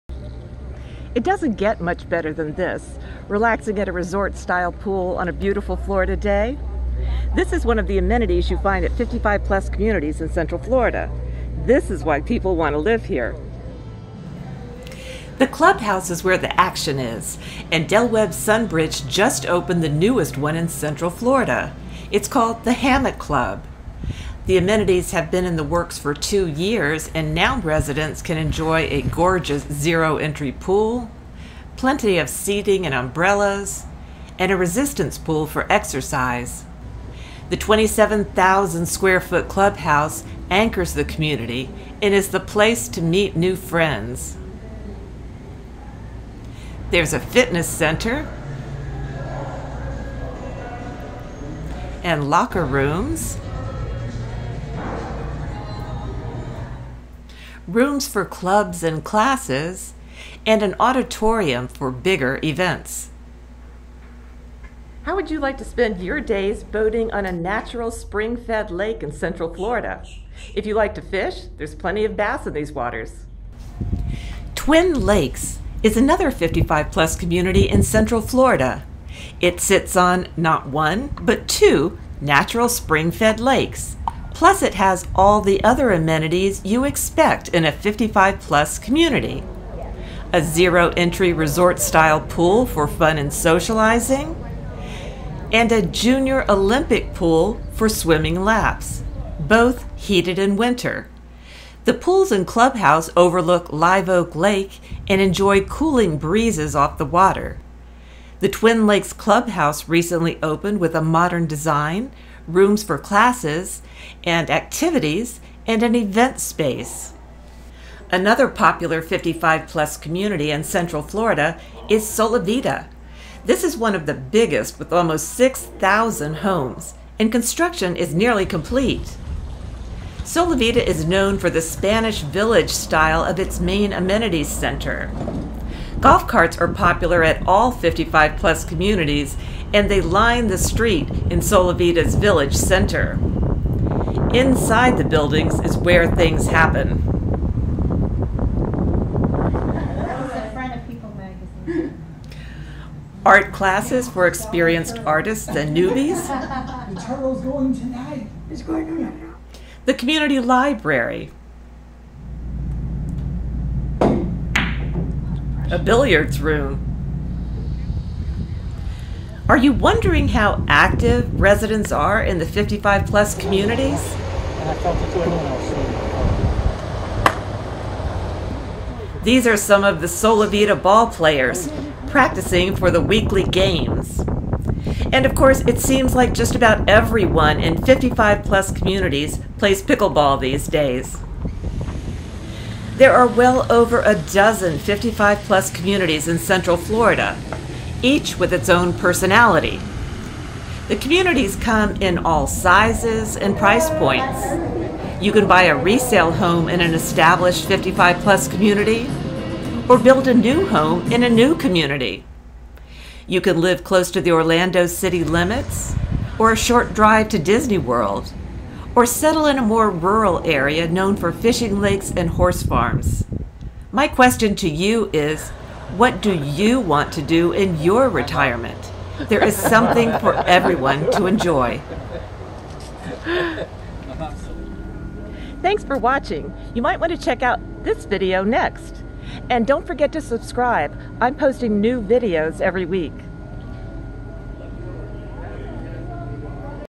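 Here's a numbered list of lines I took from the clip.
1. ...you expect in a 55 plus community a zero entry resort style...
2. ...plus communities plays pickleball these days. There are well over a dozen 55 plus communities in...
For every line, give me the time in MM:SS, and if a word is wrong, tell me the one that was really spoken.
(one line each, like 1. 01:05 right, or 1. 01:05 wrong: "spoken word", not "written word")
1. 01:26 right
2. 03:08 right.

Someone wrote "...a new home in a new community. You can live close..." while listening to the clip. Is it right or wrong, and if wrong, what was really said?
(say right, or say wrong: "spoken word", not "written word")
right.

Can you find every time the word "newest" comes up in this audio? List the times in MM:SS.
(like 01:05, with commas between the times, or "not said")
00:19.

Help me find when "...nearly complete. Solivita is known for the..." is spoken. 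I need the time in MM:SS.
02:08.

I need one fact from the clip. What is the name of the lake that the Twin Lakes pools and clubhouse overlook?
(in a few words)
Live Oak Lake.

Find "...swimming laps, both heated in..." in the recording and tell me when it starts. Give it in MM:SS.
01:37.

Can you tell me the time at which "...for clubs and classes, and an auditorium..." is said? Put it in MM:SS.
00:58.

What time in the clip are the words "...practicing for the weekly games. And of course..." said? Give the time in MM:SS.
03:02.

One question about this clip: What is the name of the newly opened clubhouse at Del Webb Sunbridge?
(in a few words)
Hammock Club.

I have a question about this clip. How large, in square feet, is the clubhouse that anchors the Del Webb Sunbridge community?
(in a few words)
27,000.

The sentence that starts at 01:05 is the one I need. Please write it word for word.
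How would you like to spend your days boating on a natural spring fed lake in central Florida?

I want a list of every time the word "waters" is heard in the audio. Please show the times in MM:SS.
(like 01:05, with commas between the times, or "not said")
01:12, 01:47.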